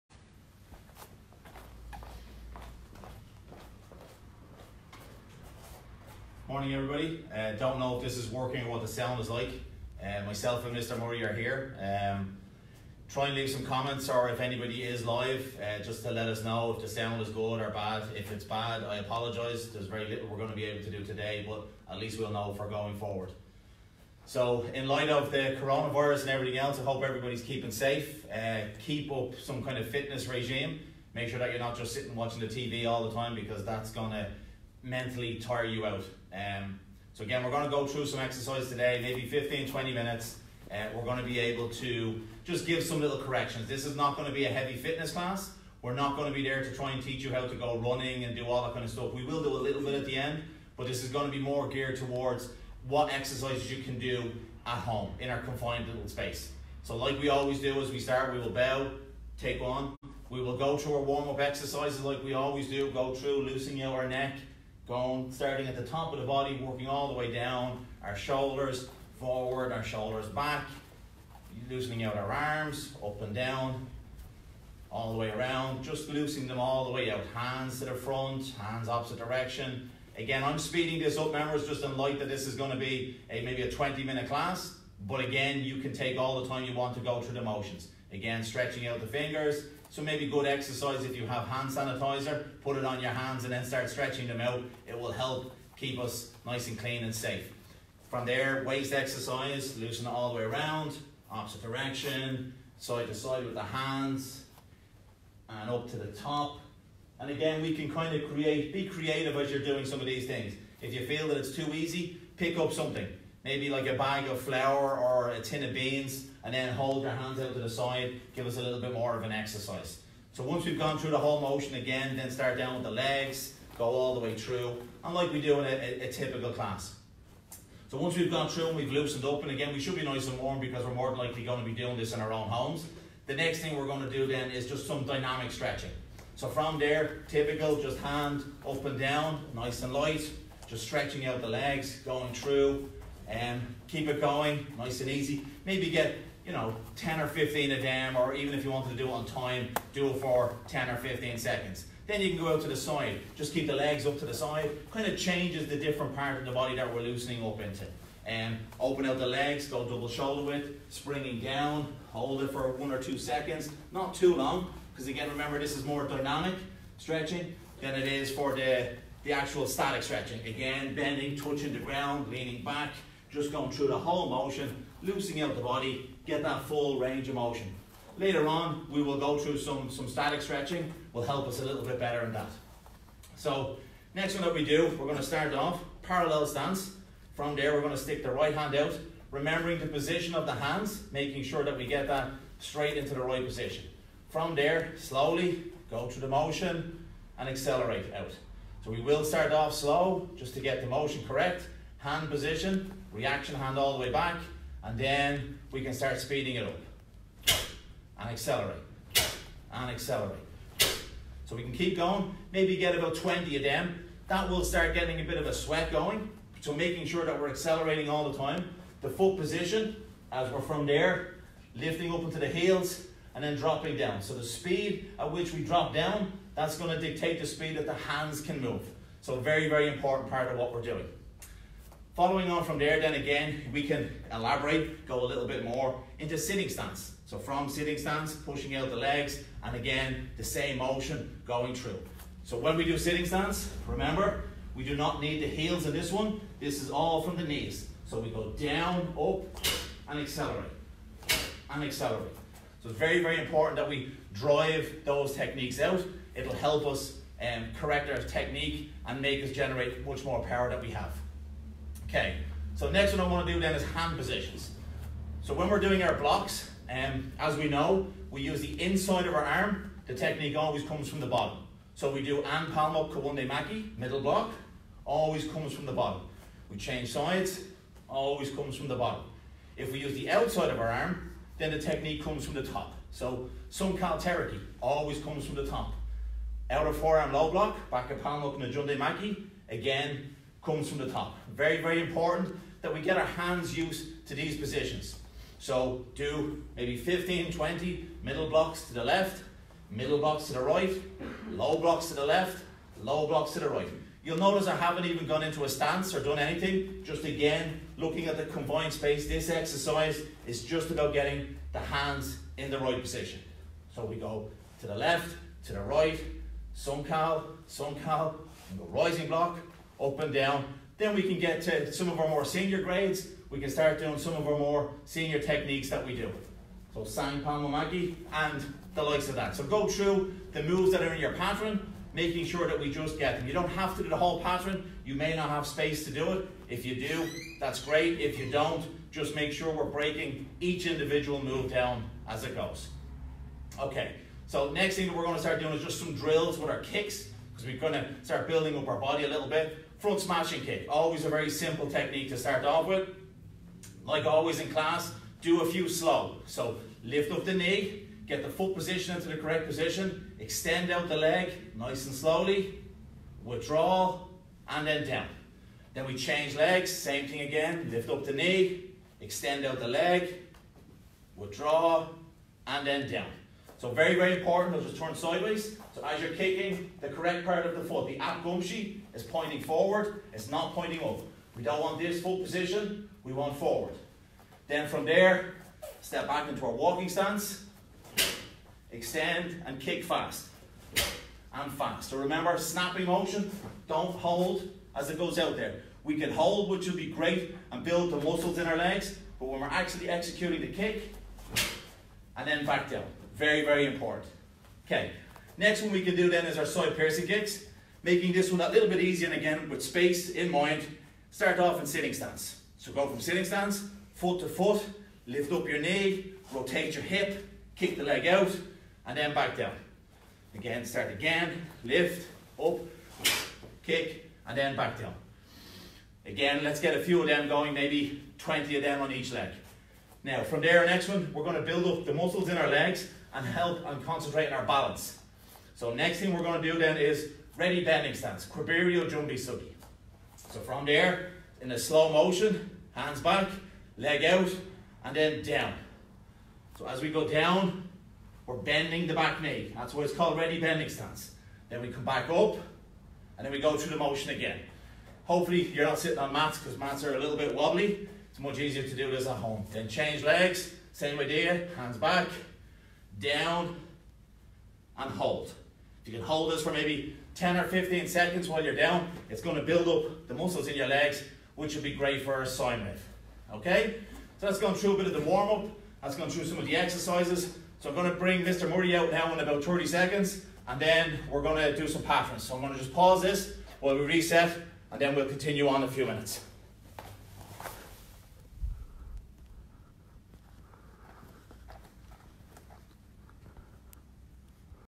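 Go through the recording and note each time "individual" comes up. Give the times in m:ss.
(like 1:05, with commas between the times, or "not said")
5:40.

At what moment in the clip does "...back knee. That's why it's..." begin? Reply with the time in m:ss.
7:29.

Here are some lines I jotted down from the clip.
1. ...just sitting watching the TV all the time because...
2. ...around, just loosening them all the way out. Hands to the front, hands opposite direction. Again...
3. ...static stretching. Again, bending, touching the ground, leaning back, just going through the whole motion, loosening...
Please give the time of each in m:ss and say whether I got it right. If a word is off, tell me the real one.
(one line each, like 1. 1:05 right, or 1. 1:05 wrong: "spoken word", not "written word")
1. 0:31 right
2. 1:15 right
3. 2:49 right.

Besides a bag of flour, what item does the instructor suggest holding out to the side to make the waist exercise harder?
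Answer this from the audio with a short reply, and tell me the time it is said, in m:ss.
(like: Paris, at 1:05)
A tin of beans, at 1:55.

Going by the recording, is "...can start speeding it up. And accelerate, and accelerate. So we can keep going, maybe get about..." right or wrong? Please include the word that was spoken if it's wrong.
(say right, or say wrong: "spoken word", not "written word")
right.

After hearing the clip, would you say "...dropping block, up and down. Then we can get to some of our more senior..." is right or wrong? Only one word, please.
wrong.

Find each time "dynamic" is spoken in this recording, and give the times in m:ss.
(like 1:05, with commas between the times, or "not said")
2:15, 2:46.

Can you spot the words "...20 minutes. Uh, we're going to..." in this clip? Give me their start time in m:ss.
0:39.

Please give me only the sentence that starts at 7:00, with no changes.
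Again, start again, lift, up, kick, and then back down.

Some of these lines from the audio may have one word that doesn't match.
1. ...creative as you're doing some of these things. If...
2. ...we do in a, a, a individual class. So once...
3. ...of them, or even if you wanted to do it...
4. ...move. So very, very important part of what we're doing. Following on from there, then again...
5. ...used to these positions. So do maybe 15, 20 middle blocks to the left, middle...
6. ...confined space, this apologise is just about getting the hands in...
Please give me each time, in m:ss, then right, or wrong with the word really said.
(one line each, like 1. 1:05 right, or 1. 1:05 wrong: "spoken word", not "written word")
1. 1:48 right
2. 2:05 wrong: "typical", not "individual"
3. 2:27 right
4. 3:48 right
5. 4:53 right
6. 5:08 wrong: "exercise", not "apologise".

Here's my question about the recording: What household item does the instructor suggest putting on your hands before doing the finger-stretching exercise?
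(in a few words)
Hand sanitizer.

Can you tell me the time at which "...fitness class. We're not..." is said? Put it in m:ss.
0:44.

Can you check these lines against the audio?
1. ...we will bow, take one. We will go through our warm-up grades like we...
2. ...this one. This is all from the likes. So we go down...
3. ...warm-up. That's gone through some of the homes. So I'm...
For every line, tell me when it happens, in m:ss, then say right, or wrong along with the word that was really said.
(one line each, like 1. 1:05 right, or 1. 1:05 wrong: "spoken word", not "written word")
1. 0:58 wrong: "exercises", not "grades"
2. 4:05 wrong: "knees", not "likes"
3. 7:55 wrong: "exercises", not "homes".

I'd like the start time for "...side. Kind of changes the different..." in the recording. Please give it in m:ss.
2:34.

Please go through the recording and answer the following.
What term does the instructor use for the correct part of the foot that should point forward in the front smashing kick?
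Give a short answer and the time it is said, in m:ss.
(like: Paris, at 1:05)
Apkumchi, at 6:18.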